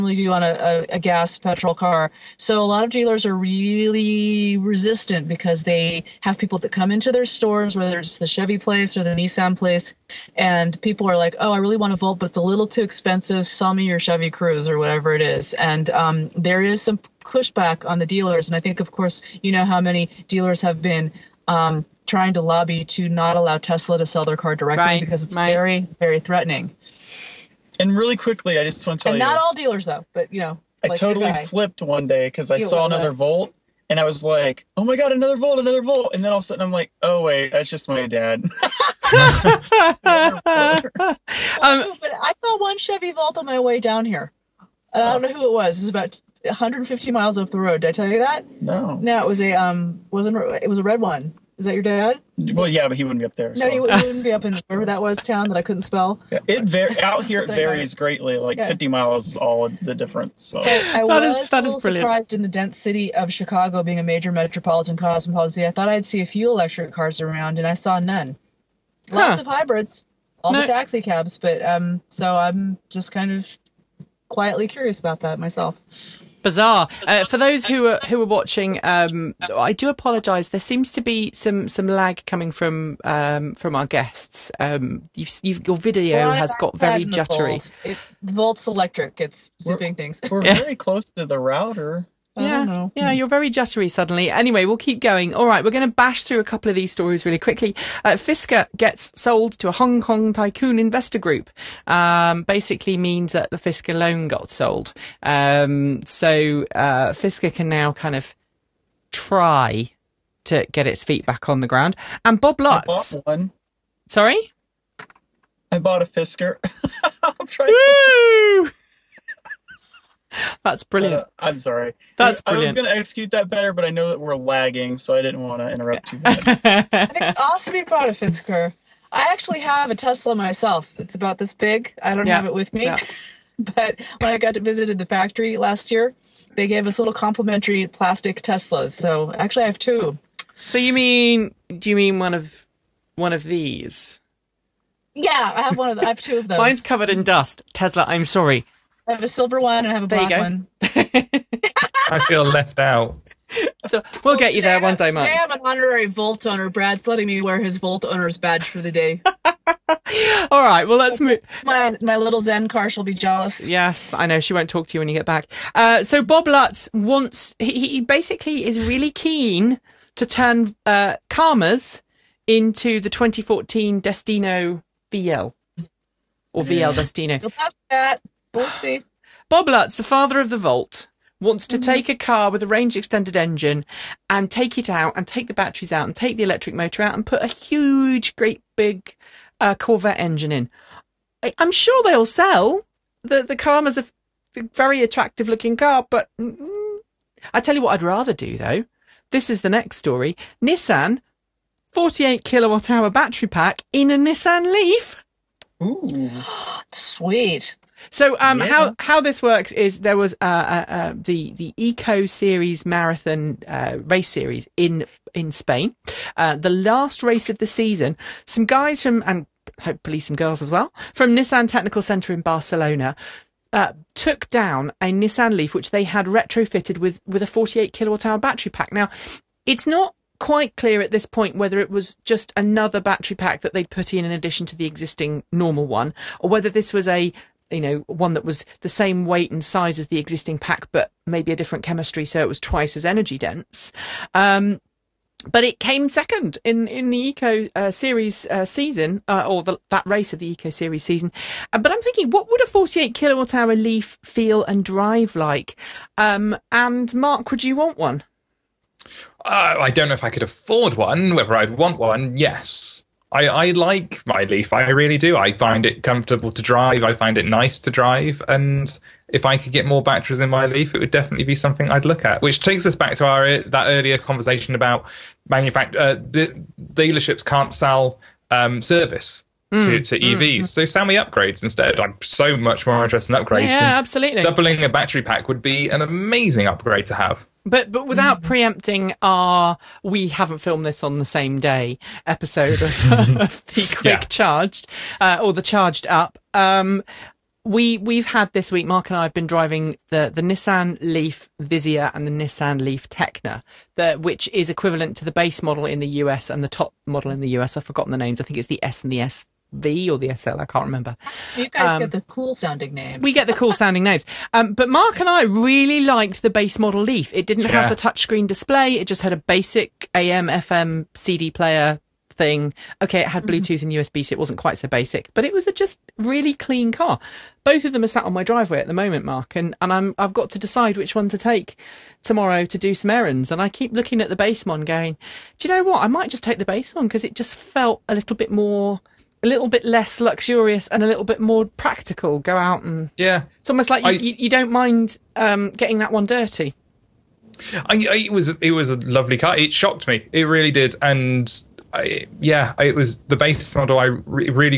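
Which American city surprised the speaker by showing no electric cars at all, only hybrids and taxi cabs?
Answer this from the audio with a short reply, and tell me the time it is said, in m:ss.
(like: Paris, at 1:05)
Chicago, at 1:03.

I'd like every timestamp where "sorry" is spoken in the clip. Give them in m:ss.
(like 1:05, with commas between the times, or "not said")
1:54, 2:01, 2:28.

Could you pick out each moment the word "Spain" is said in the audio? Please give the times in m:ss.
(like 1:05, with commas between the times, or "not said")
3:35.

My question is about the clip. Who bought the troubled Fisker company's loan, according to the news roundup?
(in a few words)
A Hong Kong tycoon investor group.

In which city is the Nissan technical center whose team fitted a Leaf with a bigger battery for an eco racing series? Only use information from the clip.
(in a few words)
Barcelona.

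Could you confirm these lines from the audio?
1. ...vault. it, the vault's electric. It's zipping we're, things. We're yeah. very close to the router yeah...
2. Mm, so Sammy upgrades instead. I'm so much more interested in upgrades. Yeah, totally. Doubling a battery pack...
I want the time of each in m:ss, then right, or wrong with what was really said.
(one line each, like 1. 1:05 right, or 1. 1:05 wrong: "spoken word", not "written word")
1. 1:27 right
2. 4:40 wrong: "absolutely", not "totally".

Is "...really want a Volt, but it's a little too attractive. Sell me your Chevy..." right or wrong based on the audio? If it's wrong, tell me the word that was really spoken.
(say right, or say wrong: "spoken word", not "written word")
wrong: "expensive", not "attractive".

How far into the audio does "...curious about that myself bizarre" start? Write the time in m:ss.
1:14.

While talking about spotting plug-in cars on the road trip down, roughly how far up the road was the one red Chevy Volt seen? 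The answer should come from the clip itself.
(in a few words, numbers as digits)
150 miles.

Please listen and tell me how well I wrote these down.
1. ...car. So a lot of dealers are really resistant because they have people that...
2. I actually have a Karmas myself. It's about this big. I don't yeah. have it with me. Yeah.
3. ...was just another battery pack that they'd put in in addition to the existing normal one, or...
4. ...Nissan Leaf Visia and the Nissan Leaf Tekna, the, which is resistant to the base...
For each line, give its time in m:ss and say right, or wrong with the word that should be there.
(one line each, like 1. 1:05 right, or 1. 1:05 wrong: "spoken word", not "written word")
1. 0:01 right
2. 2:09 wrong: "Tesla", not "Karmas"
3. 3:51 right
4. 5:00 wrong: "equivalent", not "resistant".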